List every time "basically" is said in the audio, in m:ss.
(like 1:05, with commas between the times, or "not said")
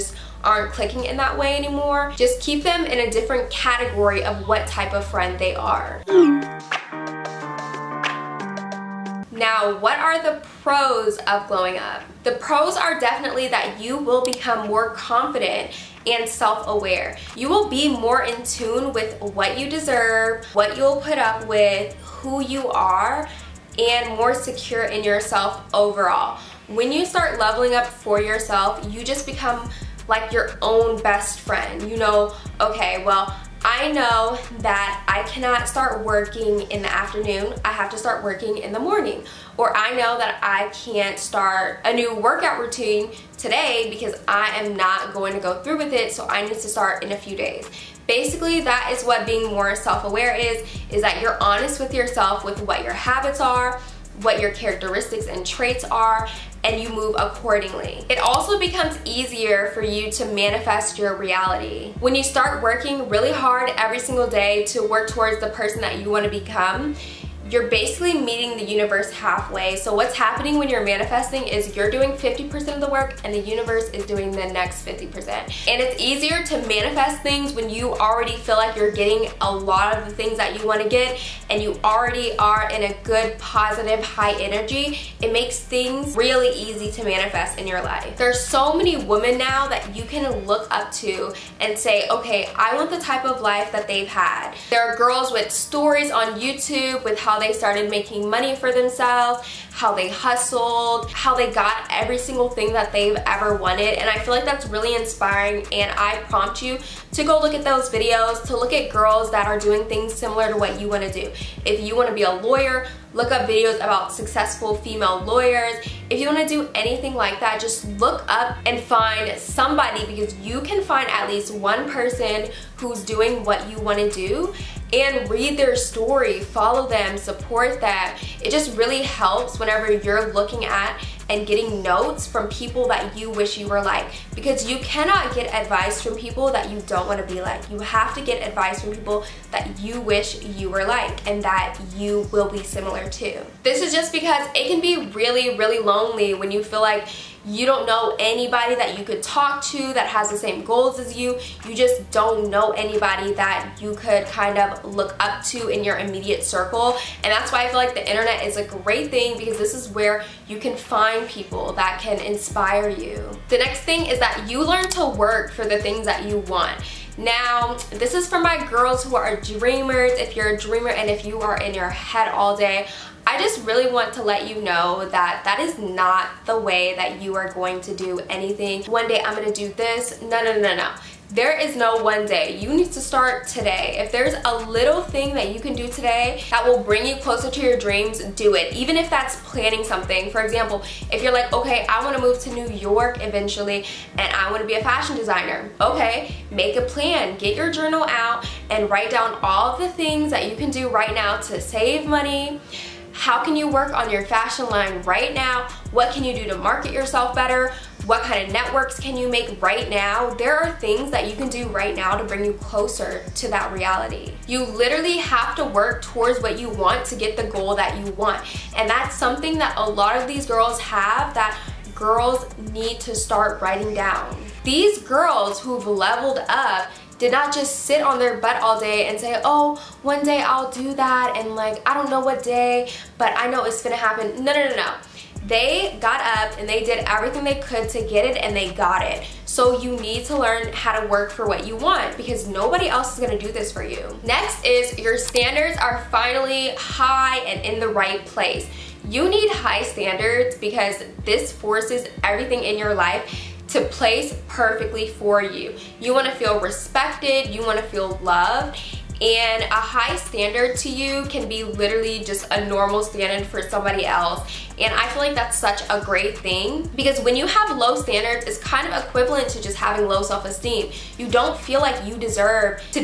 0:48, 1:07.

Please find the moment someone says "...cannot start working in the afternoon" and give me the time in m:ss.
0:35.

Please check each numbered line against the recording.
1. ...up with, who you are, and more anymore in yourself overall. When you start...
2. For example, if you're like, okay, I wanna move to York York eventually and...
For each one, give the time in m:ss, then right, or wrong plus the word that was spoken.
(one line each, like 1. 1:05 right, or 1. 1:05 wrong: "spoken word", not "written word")
1. 0:21 wrong: "secure", not "anymore"
2. 3:10 wrong: "New", not "York".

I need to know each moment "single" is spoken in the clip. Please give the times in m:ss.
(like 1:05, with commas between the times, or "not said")
1:03, 1:42.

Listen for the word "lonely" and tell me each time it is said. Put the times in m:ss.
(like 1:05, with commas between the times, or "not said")
2:25.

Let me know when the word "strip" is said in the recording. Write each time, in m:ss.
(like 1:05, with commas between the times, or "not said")
not said.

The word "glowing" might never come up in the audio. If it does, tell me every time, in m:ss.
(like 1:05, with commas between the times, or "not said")
0:11.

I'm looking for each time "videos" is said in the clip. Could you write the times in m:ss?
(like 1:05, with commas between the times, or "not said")
1:47, 1:53.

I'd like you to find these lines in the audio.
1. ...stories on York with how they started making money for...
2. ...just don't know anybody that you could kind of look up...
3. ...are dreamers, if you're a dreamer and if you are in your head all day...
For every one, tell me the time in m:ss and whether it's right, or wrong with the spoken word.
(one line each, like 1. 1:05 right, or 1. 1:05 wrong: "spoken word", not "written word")
1. 1:35 wrong: "YouTube", not "York"
2. 2:31 right
3. 2:49 right.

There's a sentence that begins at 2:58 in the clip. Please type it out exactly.
One day I'm going to do this.